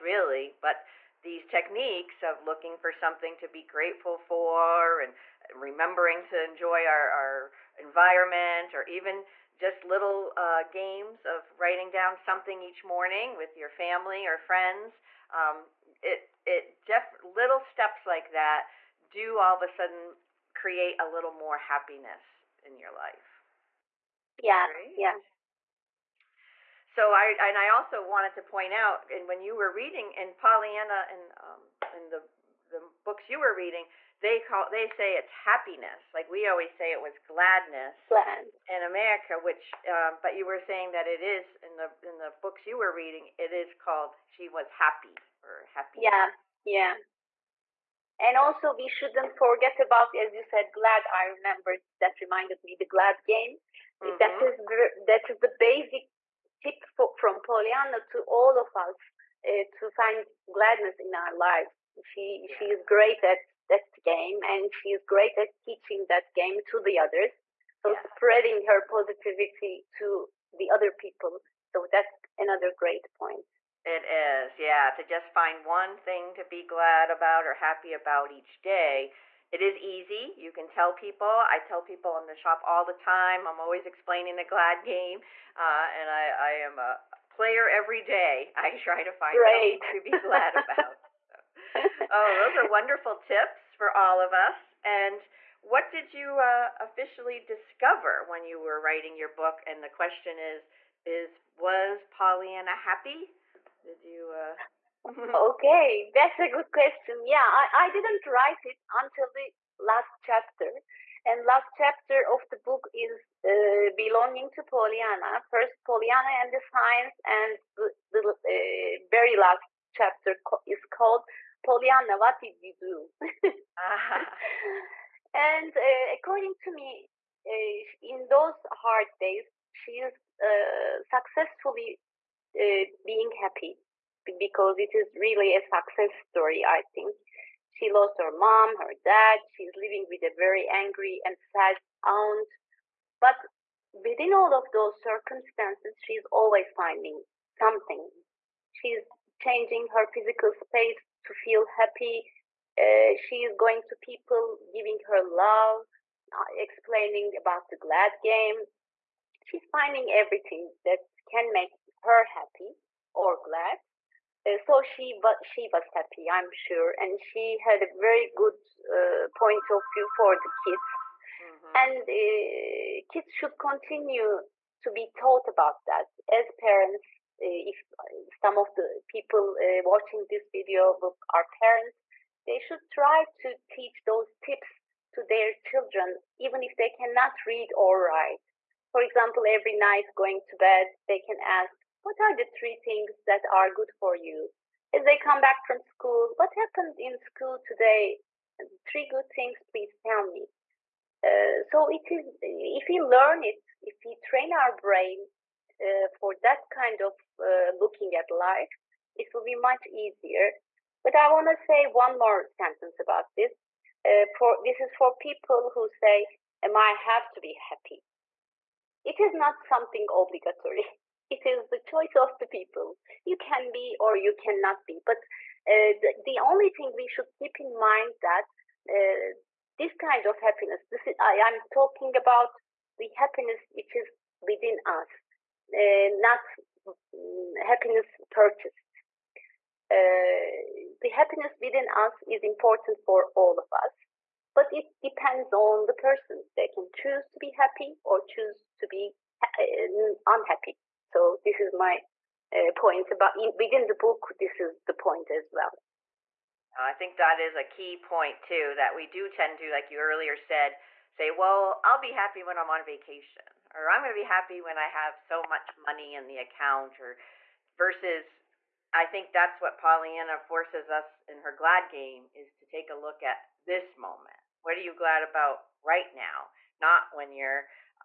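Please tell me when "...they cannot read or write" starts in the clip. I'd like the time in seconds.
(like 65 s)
186 s.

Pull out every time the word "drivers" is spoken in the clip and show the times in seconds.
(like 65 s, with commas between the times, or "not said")
not said.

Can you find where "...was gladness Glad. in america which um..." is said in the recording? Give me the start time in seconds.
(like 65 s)
37 s.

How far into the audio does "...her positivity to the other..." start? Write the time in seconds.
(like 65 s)
68 s.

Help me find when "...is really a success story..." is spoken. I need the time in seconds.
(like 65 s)
134 s.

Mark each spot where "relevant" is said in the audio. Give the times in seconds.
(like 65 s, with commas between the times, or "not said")
not said.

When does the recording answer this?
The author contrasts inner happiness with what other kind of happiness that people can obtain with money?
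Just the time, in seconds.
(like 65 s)
237 s.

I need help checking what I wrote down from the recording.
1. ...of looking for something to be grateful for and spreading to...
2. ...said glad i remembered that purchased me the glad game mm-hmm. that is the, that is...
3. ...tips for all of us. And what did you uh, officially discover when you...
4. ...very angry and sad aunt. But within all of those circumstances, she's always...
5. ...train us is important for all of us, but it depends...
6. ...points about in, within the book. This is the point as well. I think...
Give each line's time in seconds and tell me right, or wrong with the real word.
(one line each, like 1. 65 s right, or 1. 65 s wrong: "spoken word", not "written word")
1. 2 s wrong: "remembering", not "spreading"
2. 50 s wrong: "reminded", not "purchased"
3. 93 s right
4. 140 s right
5. 241 s wrong: "within", not "train"
6. 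252 s right.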